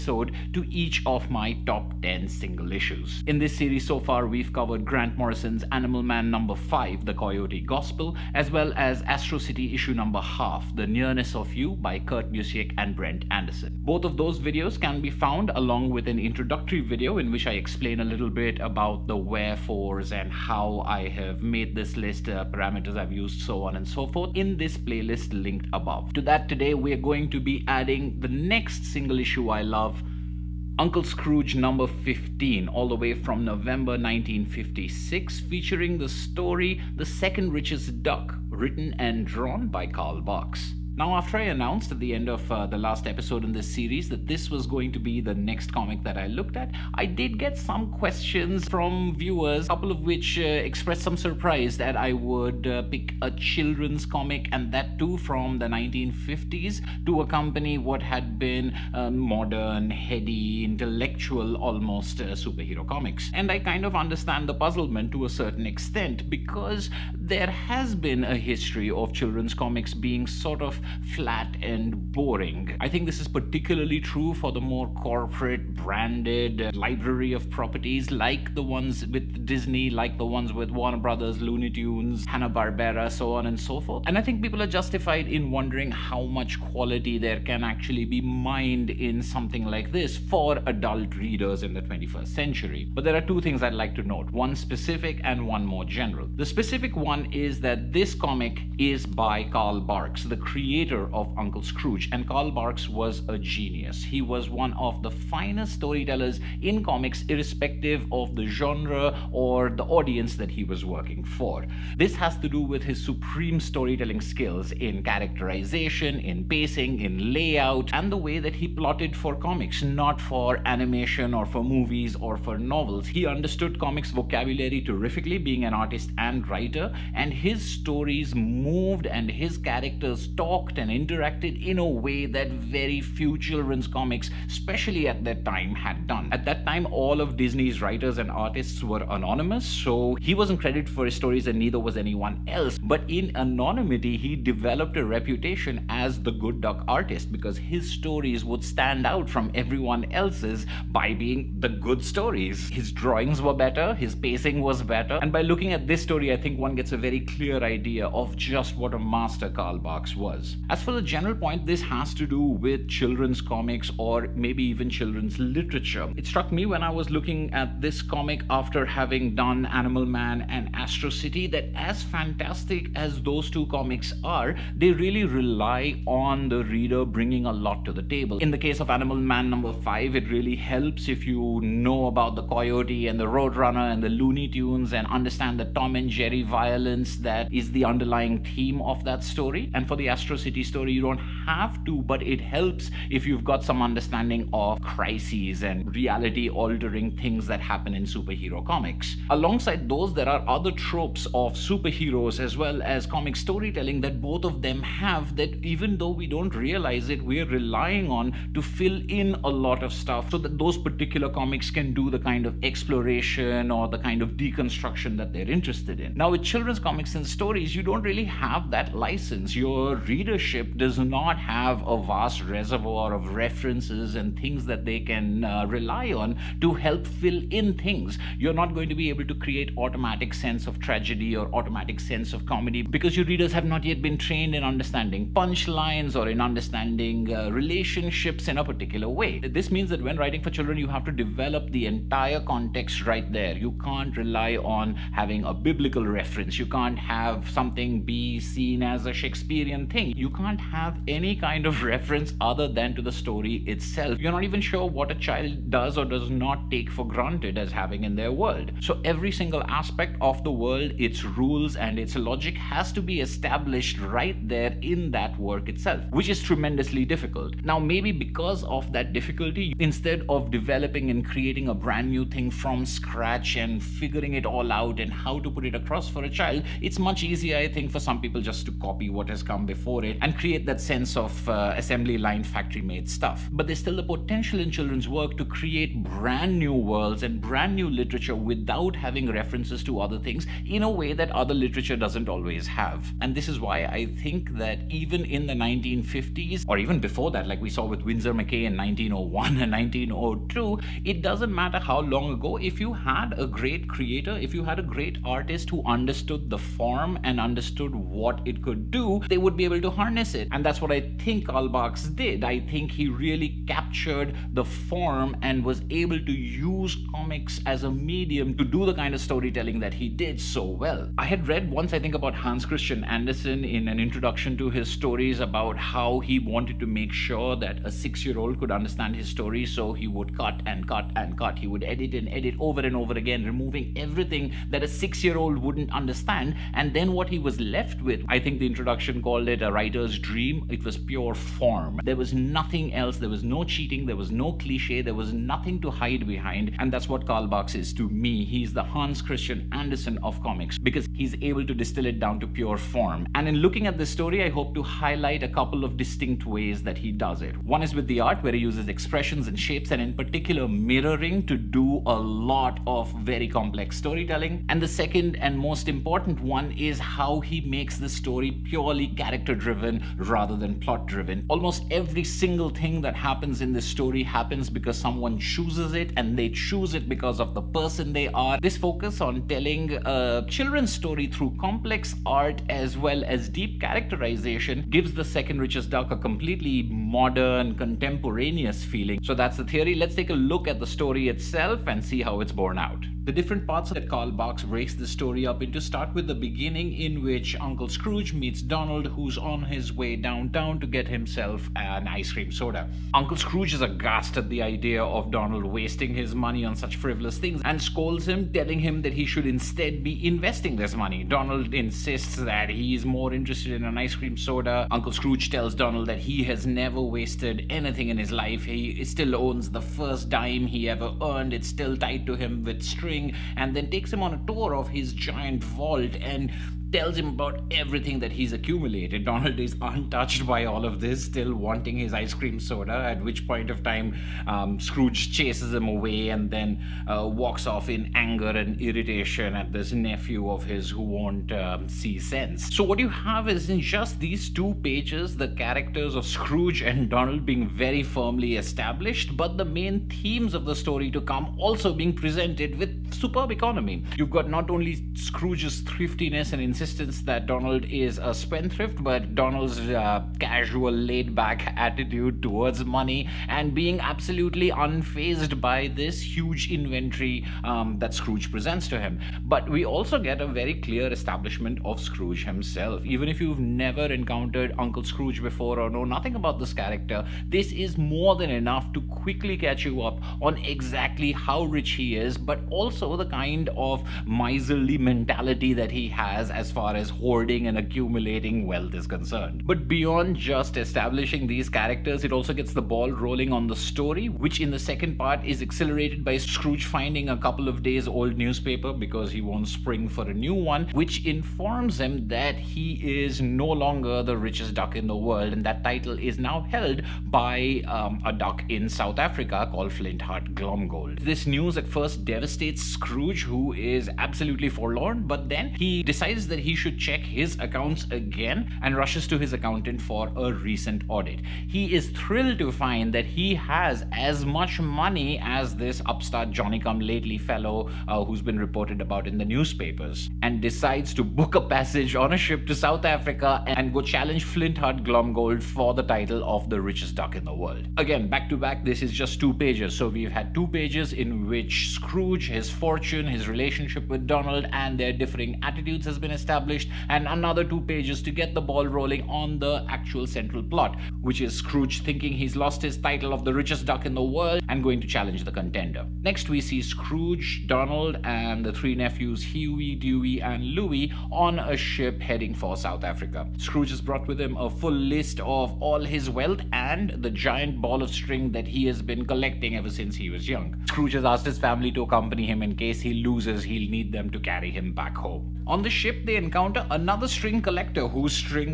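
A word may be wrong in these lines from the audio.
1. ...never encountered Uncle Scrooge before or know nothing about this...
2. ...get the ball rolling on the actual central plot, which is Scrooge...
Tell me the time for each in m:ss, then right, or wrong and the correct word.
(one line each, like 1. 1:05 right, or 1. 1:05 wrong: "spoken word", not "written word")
1. 7:53 right
2. 9:08 right.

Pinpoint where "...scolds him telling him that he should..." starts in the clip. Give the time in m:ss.
6:47.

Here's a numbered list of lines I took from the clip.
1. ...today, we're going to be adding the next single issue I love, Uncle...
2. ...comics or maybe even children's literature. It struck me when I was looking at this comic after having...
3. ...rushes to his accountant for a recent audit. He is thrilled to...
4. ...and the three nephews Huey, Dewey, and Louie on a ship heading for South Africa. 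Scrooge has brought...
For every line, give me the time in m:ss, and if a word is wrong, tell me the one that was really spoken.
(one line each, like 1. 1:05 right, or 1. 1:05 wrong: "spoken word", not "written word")
1. 0:26 right
2. 2:43 right
3. 8:38 right
4. 9:18 right.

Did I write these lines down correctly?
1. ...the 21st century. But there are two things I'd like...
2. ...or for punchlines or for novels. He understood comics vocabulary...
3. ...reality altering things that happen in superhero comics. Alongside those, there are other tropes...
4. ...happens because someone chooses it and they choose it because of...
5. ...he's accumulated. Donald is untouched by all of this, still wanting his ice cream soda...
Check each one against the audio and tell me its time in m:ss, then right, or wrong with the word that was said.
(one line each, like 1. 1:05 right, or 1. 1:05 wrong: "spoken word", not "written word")
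1. 1:31 right
2. 2:01 wrong: "movies", not "punchlines"
3. 3:15 right
4. 6:14 right
5. 7:08 right.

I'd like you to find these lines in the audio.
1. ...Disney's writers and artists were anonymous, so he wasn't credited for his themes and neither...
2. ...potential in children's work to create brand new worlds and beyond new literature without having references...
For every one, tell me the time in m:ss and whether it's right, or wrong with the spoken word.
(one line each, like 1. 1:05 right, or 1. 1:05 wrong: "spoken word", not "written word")
1. 2:17 wrong: "stories", not "themes"
2. 4:44 wrong: "brand", not "beyond".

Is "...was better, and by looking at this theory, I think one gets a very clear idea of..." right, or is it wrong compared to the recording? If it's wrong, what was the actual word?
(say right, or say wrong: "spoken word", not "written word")
wrong: "story", not "theory".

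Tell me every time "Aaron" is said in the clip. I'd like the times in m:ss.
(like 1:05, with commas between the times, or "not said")
not said.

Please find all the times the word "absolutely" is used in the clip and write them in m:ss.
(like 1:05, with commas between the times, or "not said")
7:43, 8:34.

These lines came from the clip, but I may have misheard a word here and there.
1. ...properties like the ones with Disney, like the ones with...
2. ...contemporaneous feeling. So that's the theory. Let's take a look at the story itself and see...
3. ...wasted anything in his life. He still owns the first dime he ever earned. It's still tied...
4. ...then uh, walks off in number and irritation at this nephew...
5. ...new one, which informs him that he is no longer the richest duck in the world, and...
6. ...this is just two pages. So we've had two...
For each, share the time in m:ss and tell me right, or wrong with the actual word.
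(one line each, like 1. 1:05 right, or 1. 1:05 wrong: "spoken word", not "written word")
1. 1:17 right
2. 6:27 right
3. 6:56 right
4. 7:16 wrong: "anger", not "number"
5. 8:20 right
6. 8:58 right.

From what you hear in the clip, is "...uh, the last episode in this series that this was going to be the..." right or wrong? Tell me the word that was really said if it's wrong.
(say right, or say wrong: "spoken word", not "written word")
right.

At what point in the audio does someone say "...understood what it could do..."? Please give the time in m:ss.
5:07.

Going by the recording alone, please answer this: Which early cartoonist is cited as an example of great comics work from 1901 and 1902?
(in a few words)
Winsor McCay.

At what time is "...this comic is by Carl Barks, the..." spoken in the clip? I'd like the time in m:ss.
1:37.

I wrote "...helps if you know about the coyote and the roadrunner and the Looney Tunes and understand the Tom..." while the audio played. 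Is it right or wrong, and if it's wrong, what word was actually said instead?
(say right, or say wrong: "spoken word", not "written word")
right.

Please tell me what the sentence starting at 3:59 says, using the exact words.
This means that when writing for children, you have to develop the entire context right there.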